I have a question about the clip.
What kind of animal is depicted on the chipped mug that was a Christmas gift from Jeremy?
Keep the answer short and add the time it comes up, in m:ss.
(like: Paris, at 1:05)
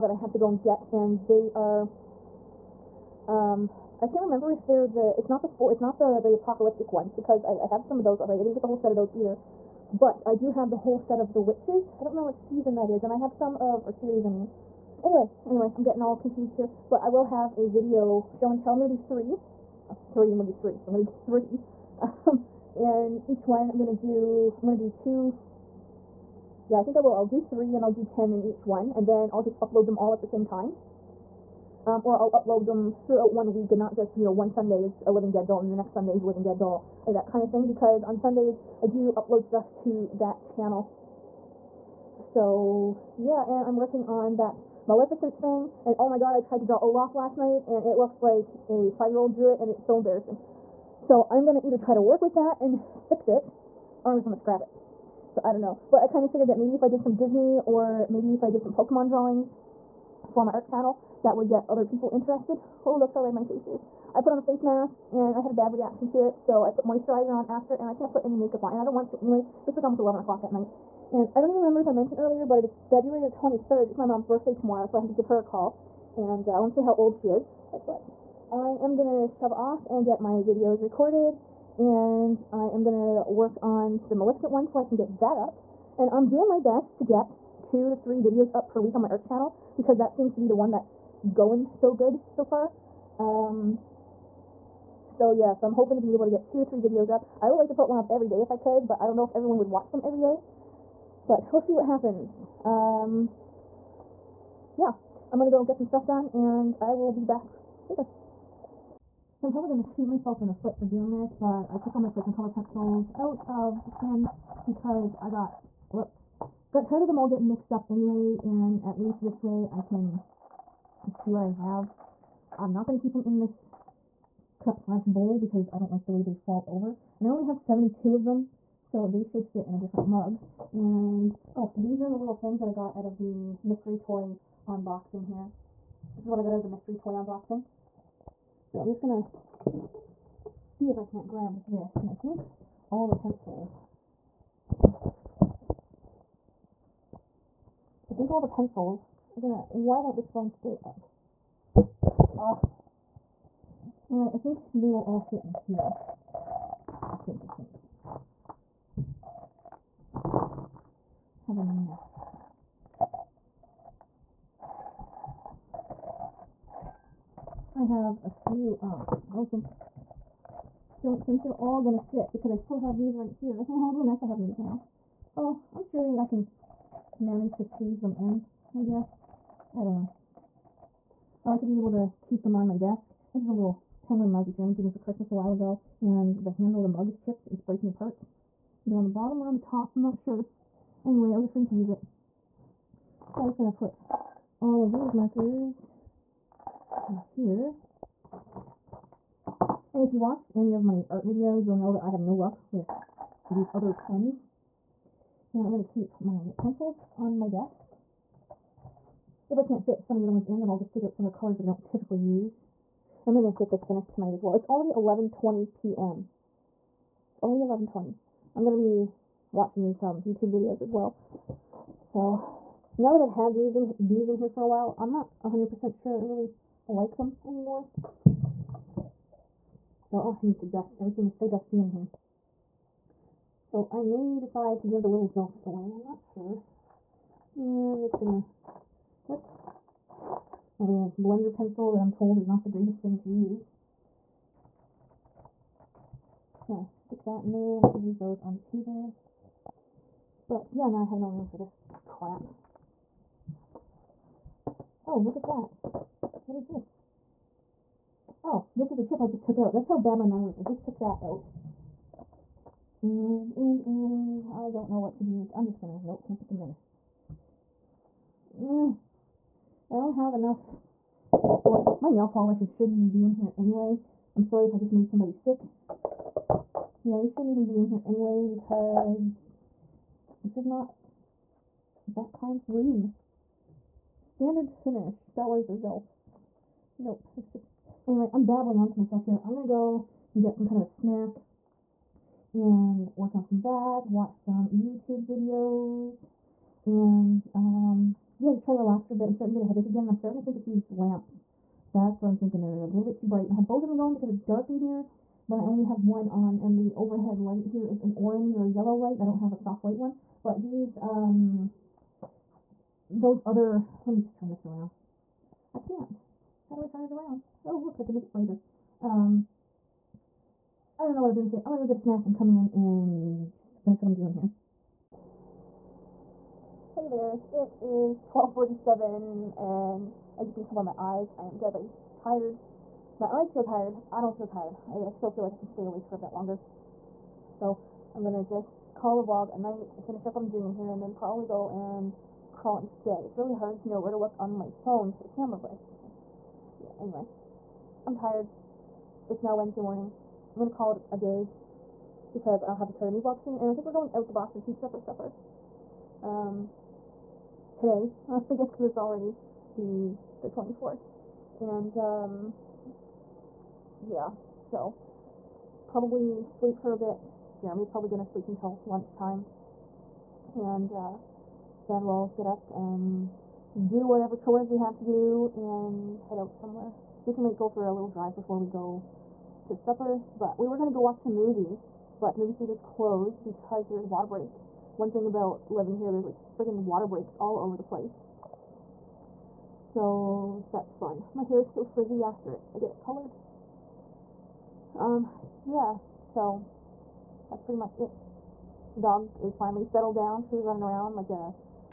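Penguin, at 3:04.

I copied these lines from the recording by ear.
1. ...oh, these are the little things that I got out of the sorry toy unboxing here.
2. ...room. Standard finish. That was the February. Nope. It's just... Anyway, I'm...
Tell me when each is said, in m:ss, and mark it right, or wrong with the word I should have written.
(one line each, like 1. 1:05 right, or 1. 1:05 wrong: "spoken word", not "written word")
1. 2:11 wrong: "mystery", not "sorry"
2. 4:42 wrong: "Zelfs", not "February".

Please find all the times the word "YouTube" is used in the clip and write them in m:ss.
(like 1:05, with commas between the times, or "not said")
3:40, 4:54.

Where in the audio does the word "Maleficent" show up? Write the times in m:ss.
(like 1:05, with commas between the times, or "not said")
0:44, 1:24.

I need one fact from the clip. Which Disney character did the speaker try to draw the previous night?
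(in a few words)
Olaf.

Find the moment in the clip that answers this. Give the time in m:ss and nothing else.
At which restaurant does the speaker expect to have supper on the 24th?
5:54.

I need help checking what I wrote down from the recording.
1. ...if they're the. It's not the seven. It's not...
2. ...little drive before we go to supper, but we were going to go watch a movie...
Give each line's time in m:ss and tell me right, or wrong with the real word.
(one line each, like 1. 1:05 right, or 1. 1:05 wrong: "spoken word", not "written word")
1. 0:04 wrong: "four", not "seven"
2. 6:17 right.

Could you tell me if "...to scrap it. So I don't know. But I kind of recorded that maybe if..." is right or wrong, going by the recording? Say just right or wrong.
wrong.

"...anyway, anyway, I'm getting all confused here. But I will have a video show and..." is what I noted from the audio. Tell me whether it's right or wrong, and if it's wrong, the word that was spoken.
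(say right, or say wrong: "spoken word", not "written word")
right.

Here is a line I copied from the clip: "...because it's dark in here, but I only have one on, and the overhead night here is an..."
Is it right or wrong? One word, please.
wrong.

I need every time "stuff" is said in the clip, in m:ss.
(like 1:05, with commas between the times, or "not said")
0:39, 1:45.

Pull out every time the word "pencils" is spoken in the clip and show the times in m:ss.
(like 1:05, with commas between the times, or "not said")
1:52, 2:23, 2:28, 3:26, 4:01.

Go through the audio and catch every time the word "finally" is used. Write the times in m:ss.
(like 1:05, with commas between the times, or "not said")
6:39.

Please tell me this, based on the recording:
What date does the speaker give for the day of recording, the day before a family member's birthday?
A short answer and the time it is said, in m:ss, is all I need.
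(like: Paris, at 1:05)
February 23rd, at 1:12.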